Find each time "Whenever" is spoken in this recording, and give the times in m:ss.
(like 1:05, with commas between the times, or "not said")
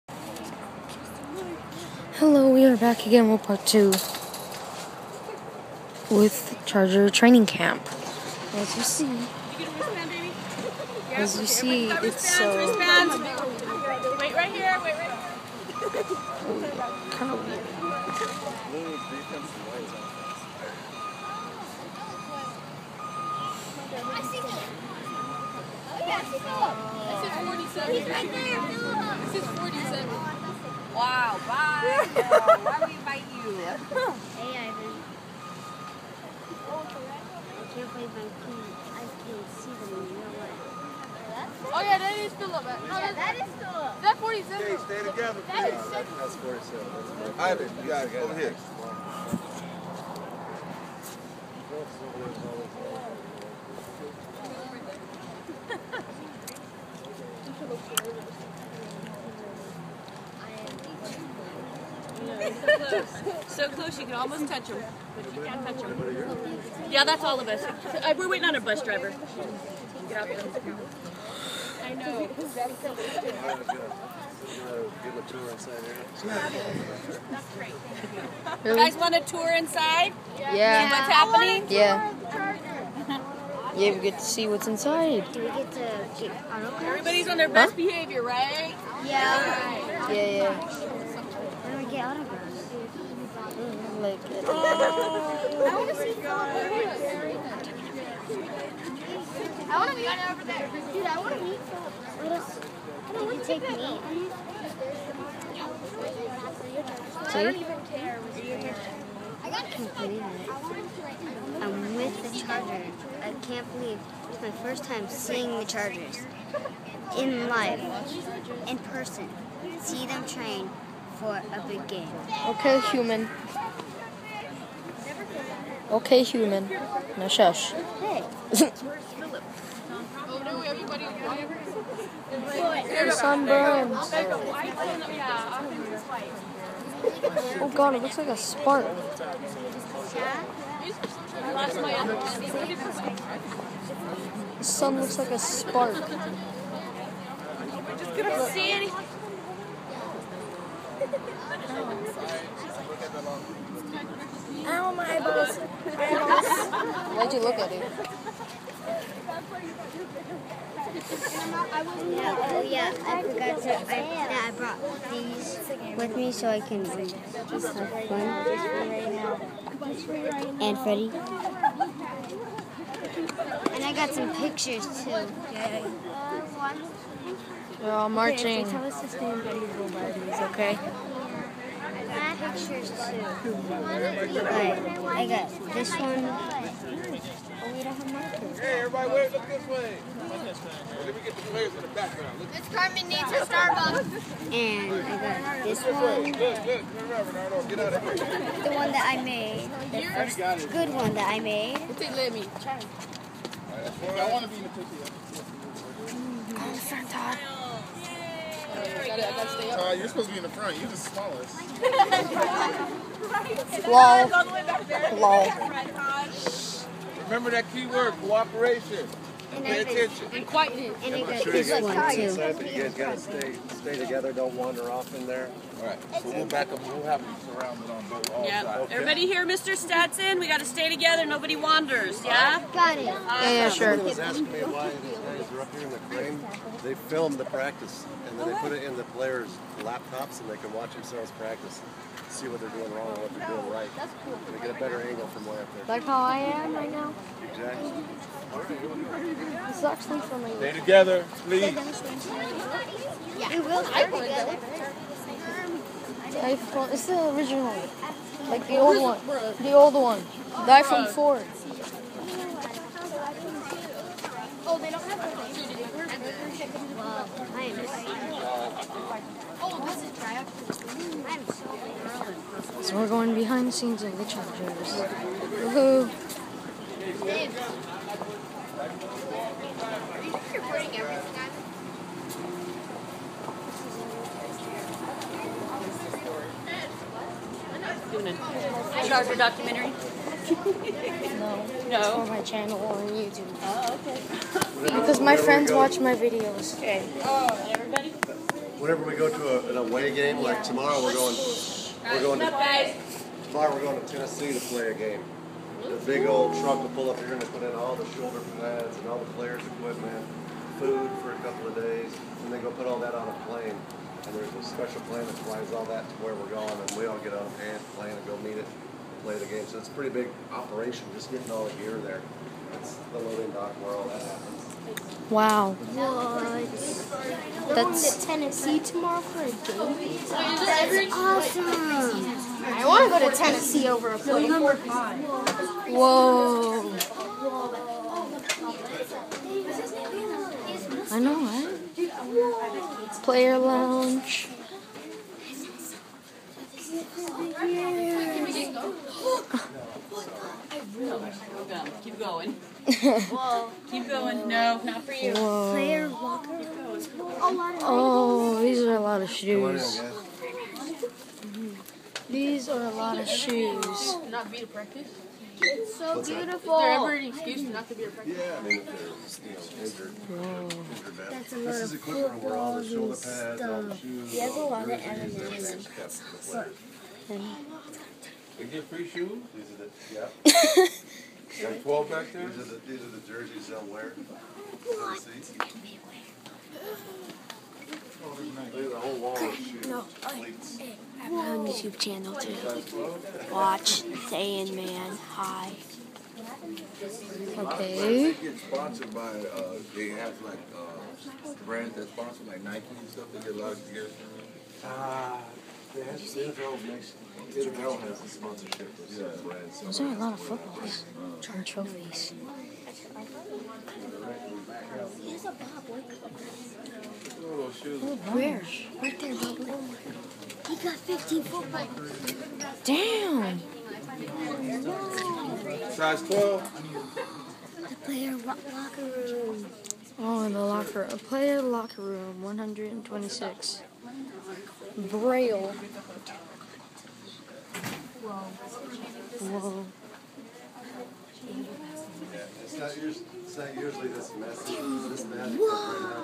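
4:58.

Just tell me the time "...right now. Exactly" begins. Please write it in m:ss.
4:06.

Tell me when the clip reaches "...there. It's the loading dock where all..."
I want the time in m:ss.
5:21.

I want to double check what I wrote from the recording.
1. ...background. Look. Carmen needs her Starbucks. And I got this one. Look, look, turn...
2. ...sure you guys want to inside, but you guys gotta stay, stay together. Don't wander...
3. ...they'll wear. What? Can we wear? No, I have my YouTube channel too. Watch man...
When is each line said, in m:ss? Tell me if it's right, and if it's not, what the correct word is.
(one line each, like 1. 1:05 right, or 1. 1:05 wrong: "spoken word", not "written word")
1. 3:11 right
2. 3:41 right
3. 6:23 right.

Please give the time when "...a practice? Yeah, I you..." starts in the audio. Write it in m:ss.
6:08.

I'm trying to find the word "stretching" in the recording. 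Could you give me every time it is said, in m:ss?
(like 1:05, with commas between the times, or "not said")
not said.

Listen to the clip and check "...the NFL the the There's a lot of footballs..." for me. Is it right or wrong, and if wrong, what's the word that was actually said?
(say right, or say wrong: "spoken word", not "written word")
right.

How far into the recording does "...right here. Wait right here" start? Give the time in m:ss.
0:14.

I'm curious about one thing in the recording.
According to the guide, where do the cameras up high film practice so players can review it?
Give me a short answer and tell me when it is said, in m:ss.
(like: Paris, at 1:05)
the crane, at 3:55.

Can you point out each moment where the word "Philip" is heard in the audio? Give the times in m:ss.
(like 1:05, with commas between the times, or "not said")
1:36, 1:41.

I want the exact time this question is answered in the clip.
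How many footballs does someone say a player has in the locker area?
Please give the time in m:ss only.
7:00.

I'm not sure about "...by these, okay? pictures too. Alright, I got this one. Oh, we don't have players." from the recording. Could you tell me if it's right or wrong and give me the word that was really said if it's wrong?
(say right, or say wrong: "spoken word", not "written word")
wrong: "markers", not "players".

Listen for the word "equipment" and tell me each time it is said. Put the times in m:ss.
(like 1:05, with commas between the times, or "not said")
5:09, 6:11.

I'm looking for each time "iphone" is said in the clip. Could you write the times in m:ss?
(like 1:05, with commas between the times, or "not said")
4:16, 4:20.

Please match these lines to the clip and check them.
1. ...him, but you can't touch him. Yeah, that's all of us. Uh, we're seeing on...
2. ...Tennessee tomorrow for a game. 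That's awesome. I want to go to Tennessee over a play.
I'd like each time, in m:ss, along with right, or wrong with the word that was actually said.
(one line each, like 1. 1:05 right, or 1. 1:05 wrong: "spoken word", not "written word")
1. 1:04 wrong: "waiting", not "seeing"
2. 5:28 right.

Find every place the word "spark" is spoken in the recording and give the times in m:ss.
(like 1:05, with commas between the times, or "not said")
2:18, 2:25.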